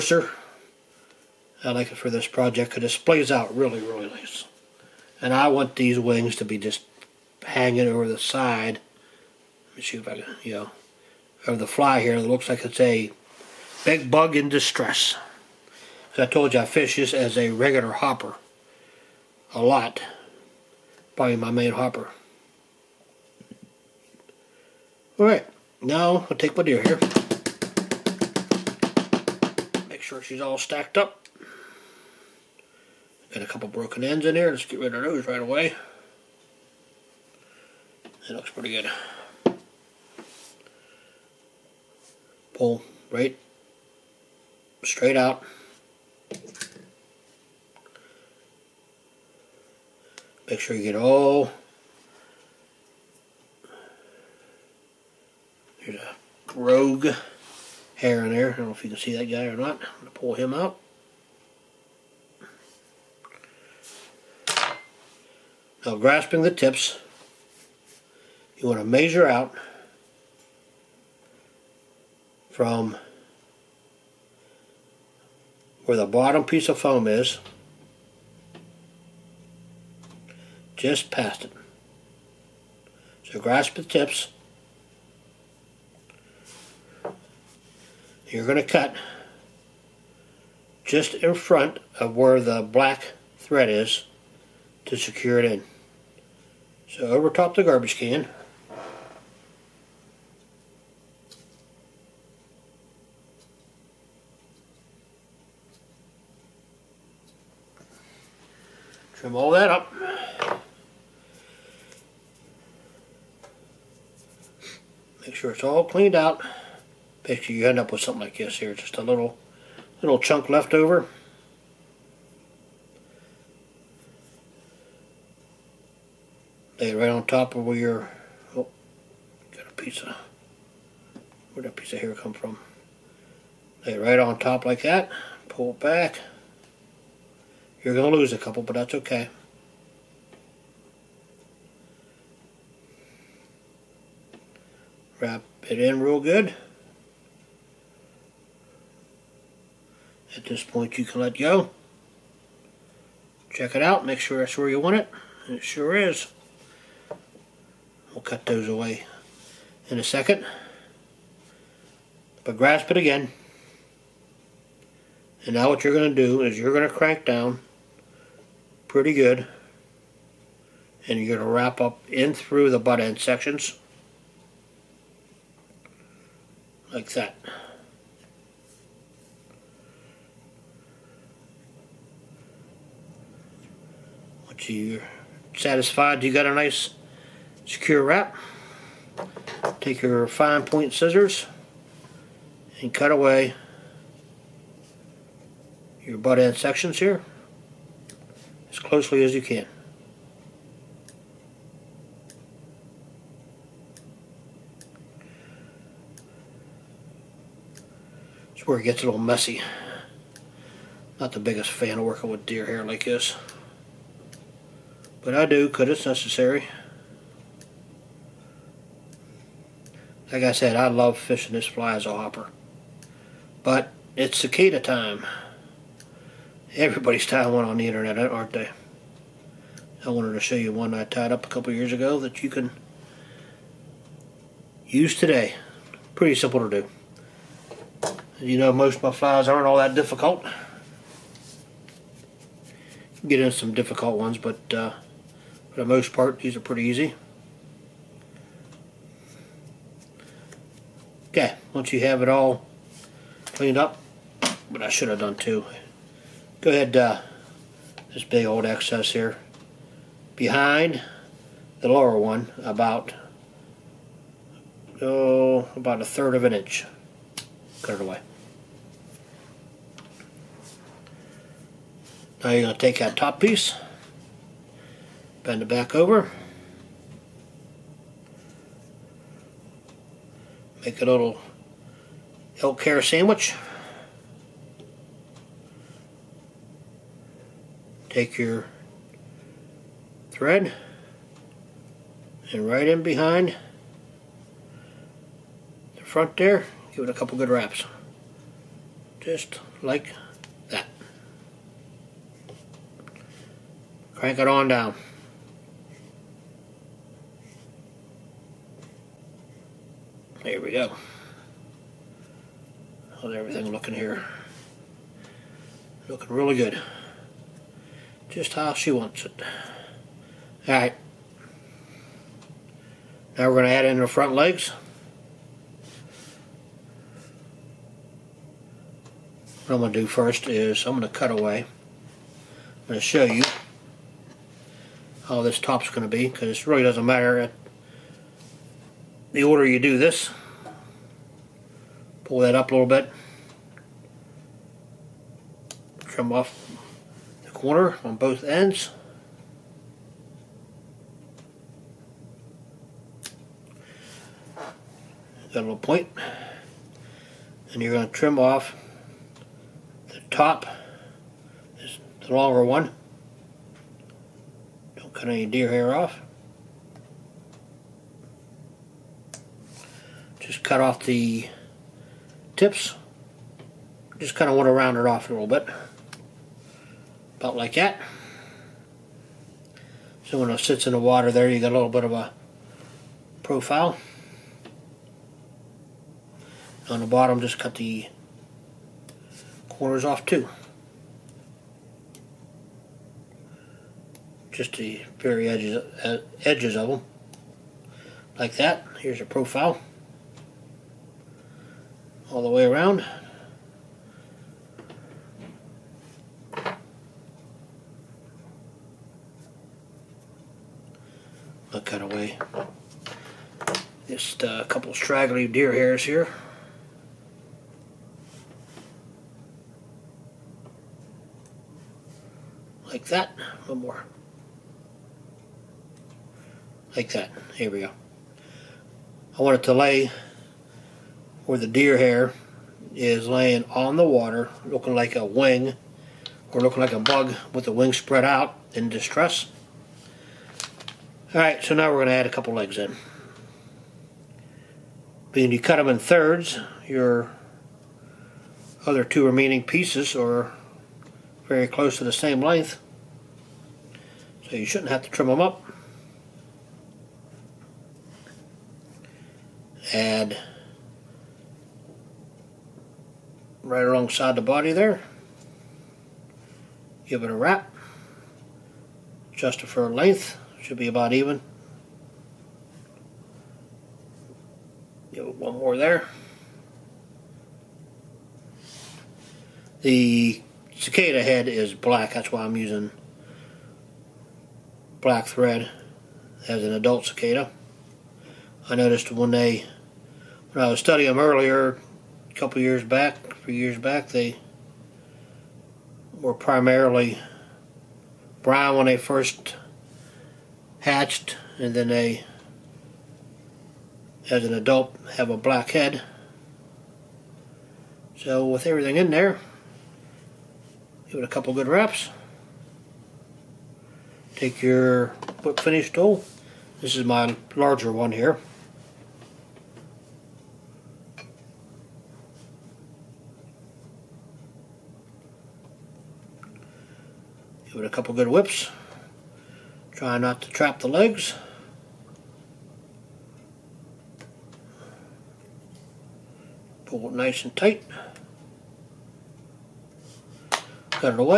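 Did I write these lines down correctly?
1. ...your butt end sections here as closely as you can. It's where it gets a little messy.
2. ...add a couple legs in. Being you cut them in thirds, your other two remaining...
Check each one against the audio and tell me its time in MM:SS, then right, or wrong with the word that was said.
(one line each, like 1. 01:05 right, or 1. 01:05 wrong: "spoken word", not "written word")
1. 03:16 right
2. 07:22 right.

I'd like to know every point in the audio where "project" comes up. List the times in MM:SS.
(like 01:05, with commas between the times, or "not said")
00:02.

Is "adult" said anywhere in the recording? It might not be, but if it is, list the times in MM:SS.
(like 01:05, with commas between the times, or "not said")
08:06, 08:24.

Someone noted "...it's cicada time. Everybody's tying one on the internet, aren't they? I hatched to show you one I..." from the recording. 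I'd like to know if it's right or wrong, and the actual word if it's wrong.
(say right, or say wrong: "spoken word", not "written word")
wrong: "wanted", not "hatched".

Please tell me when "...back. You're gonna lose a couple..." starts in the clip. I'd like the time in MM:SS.
02:15.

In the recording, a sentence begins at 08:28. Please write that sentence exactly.
So with everything in there, give it a couple good wraps.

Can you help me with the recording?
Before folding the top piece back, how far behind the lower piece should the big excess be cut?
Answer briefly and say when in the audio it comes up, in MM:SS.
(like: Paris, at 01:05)
a third of an inch, at 04:25.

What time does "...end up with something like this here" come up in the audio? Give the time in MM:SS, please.
01:57.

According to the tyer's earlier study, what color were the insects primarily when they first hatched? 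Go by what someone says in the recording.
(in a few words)
brown.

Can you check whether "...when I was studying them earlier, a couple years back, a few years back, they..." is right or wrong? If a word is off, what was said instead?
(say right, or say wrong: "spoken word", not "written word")
right.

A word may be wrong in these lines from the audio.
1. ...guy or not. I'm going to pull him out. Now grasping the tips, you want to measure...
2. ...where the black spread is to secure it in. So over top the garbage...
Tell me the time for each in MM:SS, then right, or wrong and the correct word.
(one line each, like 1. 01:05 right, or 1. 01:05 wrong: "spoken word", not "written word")
1. 00:59 right
2. 01:32 wrong: "thread", not "spread".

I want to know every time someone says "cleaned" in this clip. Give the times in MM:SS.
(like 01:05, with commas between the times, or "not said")
01:55, 04:13.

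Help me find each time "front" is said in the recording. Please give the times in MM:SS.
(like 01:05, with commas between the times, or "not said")
01:31, 04:56, 05:24.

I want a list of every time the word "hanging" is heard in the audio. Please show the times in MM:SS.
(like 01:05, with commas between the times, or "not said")
00:07.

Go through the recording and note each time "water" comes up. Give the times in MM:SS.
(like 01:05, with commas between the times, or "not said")
06:20, 07:14.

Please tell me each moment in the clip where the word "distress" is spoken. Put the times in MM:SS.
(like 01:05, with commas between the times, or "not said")
00:14, 07:18.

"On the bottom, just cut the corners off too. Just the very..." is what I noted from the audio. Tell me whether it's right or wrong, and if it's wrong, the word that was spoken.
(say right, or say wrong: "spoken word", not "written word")
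right.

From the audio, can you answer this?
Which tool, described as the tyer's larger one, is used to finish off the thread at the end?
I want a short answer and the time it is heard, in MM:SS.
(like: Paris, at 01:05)
whip finish tool, at 08:35.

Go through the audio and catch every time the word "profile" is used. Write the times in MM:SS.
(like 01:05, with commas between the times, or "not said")
06:23, 06:39.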